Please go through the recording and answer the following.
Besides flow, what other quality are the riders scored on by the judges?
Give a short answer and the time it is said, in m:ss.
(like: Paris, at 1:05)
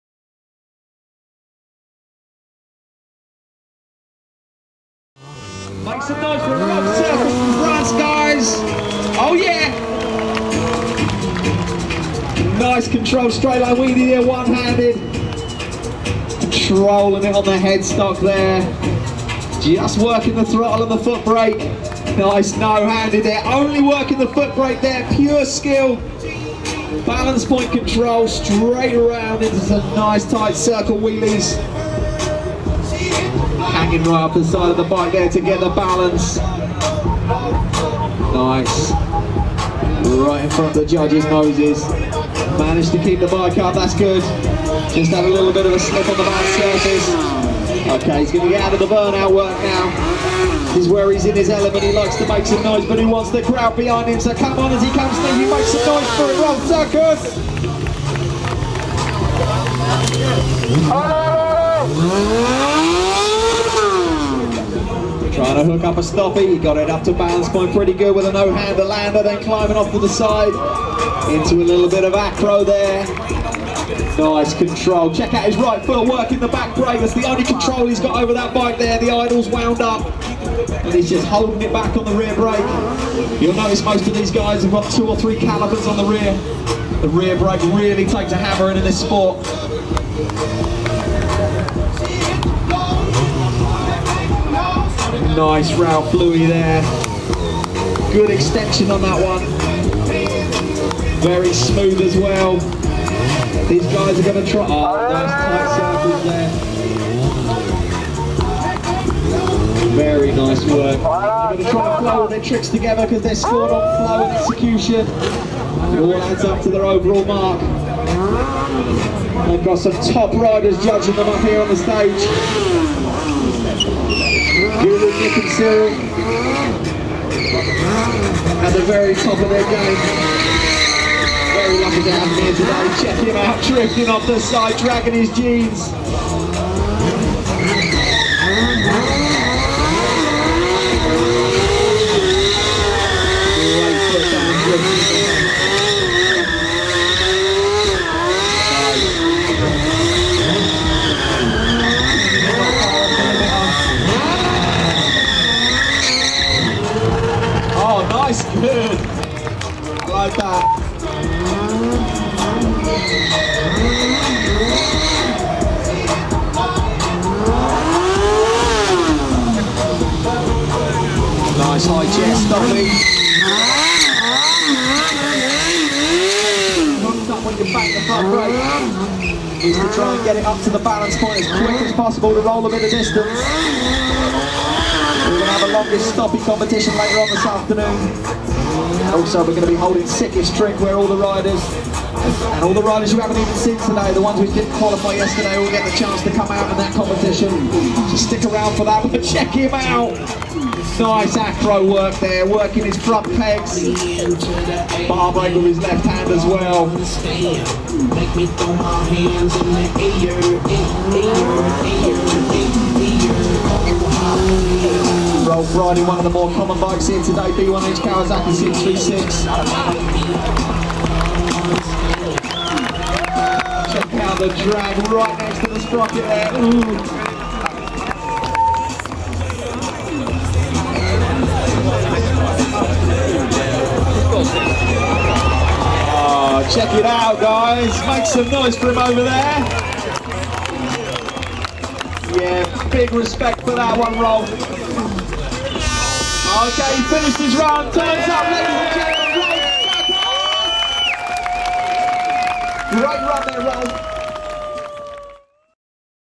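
Execution, at 1:54.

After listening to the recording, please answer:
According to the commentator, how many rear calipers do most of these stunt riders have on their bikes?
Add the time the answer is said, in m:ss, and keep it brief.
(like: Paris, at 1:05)
2 or 3, at 1:24.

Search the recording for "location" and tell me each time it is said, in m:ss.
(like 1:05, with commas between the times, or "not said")
not said.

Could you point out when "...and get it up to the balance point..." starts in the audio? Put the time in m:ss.
3:00.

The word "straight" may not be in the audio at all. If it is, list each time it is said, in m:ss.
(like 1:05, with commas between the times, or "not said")
0:13, 0:28.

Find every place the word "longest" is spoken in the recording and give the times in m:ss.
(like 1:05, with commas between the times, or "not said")
3:05.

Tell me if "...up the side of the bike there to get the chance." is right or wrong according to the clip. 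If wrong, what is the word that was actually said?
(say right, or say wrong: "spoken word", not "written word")
wrong: "balance", not "chance".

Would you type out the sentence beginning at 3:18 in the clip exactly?
Just stick around for that, but check him out!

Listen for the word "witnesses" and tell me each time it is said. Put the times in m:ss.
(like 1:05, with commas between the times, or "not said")
not said.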